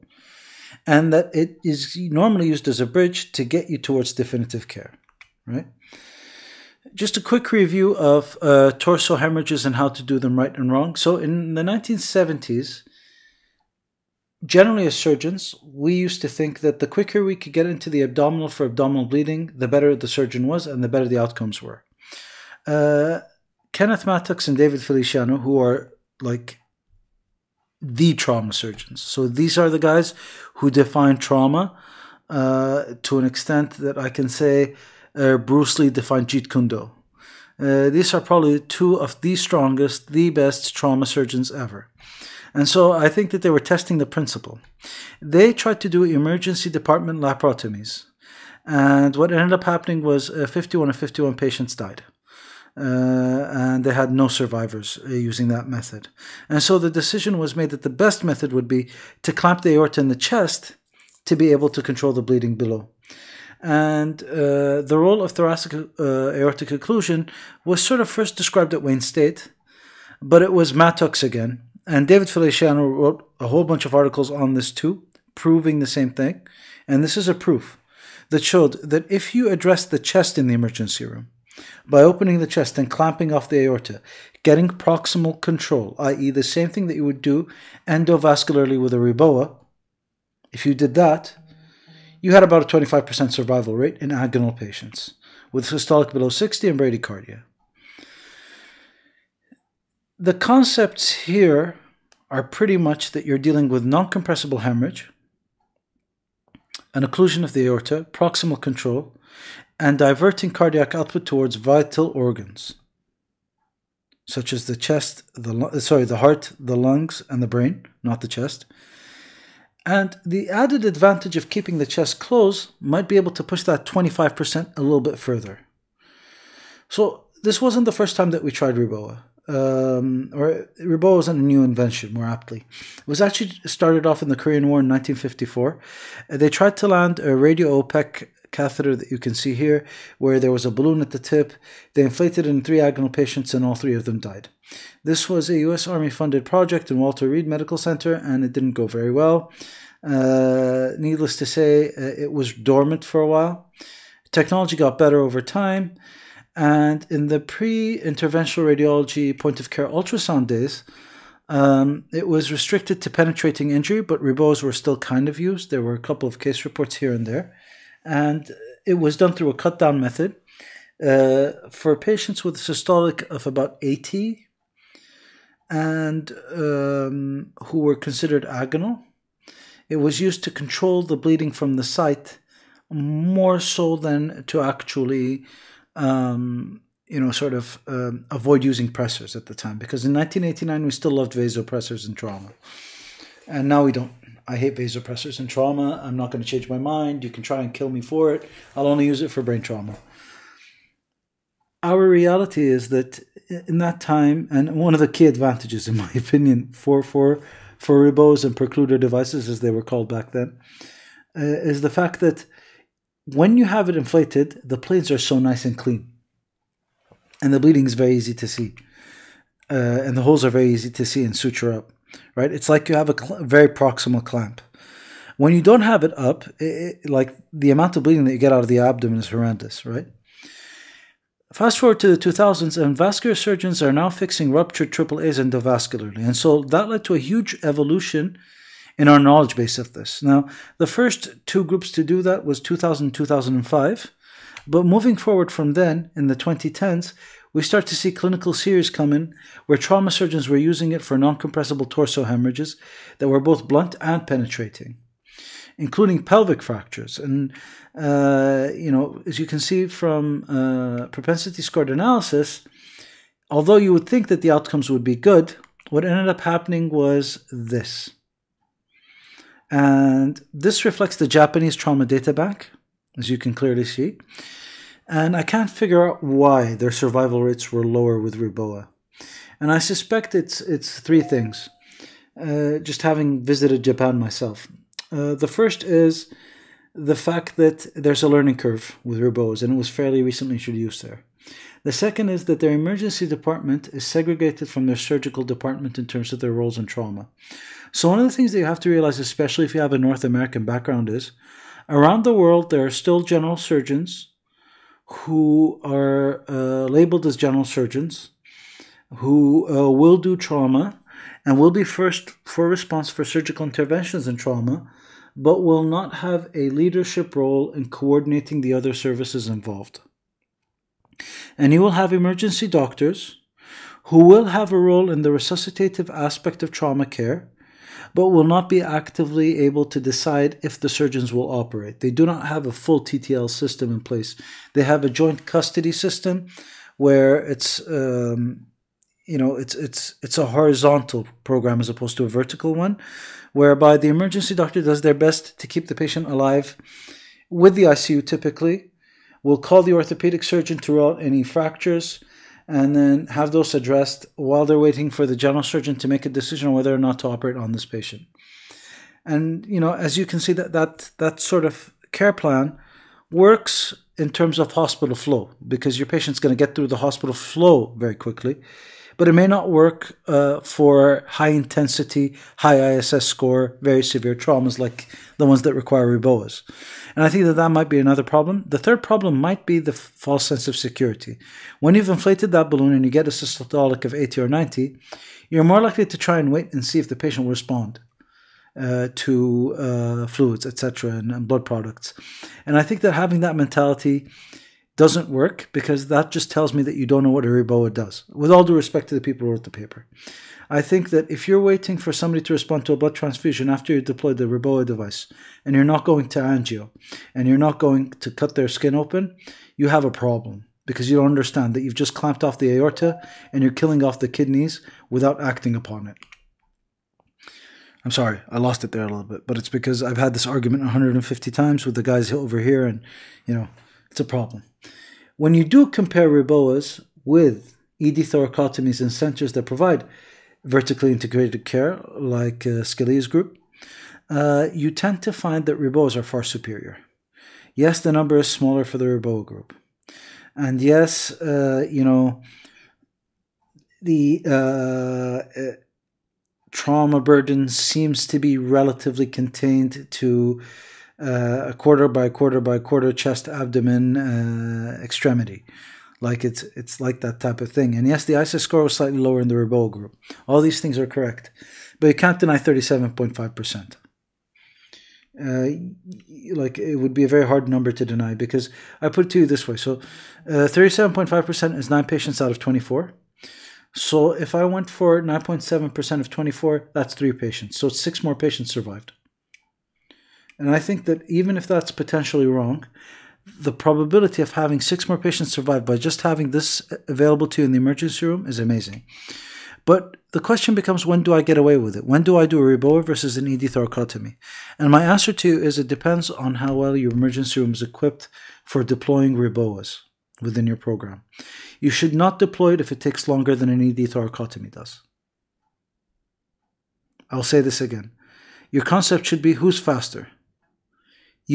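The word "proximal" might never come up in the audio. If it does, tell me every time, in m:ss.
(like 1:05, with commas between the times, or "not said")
1:24, 1:48, 3:43.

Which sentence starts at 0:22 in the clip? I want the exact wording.
Uh, Kenneth Mattox and David Feliciano, who are like the trauma surgeons.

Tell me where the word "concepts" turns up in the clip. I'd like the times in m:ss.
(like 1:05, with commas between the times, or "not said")
1:40, 8:28.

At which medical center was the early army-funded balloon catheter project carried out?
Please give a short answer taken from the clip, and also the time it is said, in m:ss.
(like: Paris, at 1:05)
Walter Reed Medical Center, at 2:26.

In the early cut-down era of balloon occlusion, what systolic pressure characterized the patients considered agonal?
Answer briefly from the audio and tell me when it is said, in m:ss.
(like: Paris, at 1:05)
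80, at 2:53.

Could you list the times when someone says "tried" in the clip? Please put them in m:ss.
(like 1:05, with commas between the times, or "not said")
0:45, 2:08, 2:16.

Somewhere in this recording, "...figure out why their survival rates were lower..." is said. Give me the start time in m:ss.
4:35.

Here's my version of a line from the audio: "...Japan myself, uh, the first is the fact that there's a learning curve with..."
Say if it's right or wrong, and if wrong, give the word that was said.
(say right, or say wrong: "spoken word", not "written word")
right.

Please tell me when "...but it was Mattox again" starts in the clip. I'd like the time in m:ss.
1:10.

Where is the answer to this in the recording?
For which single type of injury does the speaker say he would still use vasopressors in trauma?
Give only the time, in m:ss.
3:19.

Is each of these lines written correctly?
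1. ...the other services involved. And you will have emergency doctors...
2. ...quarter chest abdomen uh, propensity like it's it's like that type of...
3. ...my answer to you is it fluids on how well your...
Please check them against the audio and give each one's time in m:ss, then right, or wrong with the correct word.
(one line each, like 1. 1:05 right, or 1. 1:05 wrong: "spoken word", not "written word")
1. 5:18 right
2. 7:32 wrong: "extremity", not "propensity"
3. 8:14 wrong: "depends", not "fluids".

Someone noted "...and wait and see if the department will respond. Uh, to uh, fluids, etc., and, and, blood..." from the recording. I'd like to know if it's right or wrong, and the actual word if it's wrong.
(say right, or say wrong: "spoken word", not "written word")
wrong: "patient", not "department".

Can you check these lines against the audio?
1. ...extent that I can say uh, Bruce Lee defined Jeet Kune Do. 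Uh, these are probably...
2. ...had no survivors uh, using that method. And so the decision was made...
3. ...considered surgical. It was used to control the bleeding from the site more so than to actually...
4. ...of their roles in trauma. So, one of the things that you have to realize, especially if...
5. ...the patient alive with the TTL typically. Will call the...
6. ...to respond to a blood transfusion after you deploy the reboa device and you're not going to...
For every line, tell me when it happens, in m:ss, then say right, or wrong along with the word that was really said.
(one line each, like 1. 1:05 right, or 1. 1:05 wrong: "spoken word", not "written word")
1. 0:33 right
2. 0:53 right
3. 2:57 wrong: "agonal", not "surgical"
4. 4:56 right
5. 5:45 wrong: "ICU", not "TTL"
6. 6:42 right.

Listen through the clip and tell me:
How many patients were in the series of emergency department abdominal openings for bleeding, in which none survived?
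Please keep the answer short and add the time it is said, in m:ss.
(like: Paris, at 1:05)
51, at 0:50.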